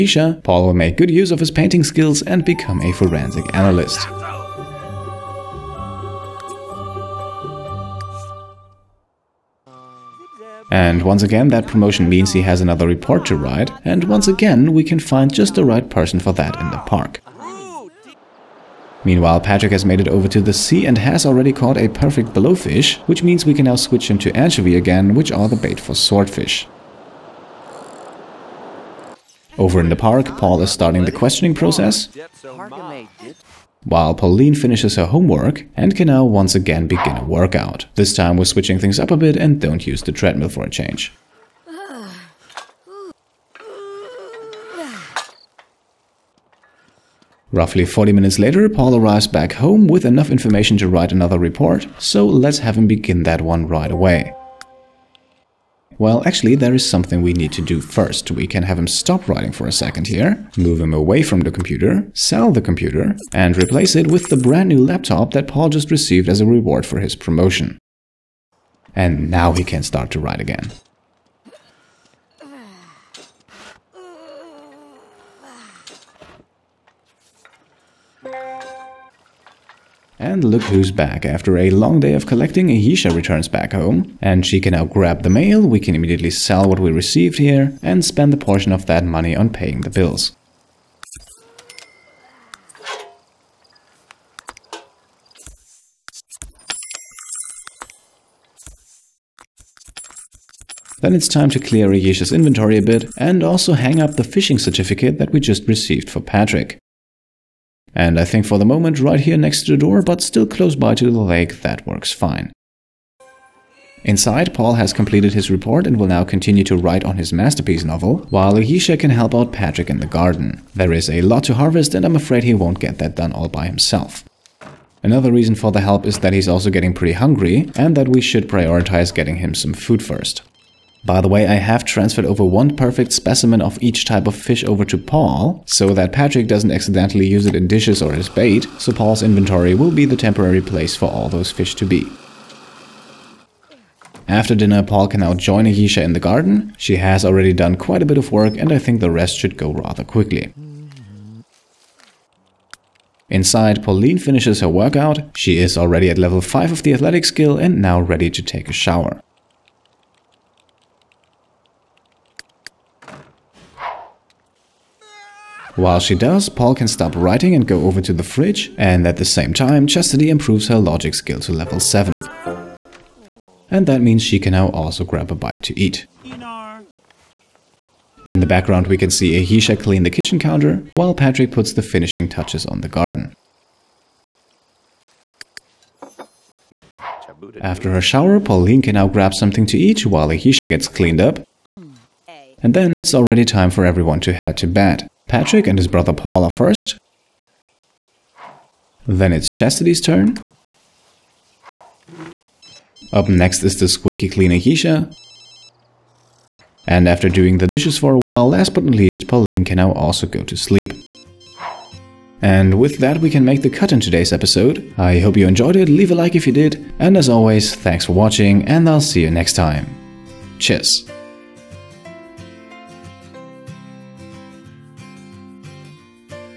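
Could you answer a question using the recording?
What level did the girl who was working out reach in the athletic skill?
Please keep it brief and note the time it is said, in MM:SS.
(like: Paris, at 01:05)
5, at 02:36.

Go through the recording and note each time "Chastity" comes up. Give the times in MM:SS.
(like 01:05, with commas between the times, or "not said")
02:49, 03:19.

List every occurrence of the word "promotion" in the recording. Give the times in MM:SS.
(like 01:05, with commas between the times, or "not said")
00:11, 01:07.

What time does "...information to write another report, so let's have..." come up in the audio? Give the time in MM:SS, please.
00:50.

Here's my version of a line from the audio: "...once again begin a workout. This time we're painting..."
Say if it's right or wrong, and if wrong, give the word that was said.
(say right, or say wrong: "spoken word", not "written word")
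wrong: "switching", not "painting".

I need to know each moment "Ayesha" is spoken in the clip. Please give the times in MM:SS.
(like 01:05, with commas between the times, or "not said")
01:22, 01:41, 01:58, 02:25, 02:59, 03:10, 03:24.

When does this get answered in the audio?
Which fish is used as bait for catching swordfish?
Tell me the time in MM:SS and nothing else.
00:24.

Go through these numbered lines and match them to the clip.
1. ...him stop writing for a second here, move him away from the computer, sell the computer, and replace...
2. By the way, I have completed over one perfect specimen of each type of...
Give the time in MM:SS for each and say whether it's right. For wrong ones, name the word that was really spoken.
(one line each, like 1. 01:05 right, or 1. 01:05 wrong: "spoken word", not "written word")
1. 00:58 right
2. 02:11 wrong: "transferred", not "completed".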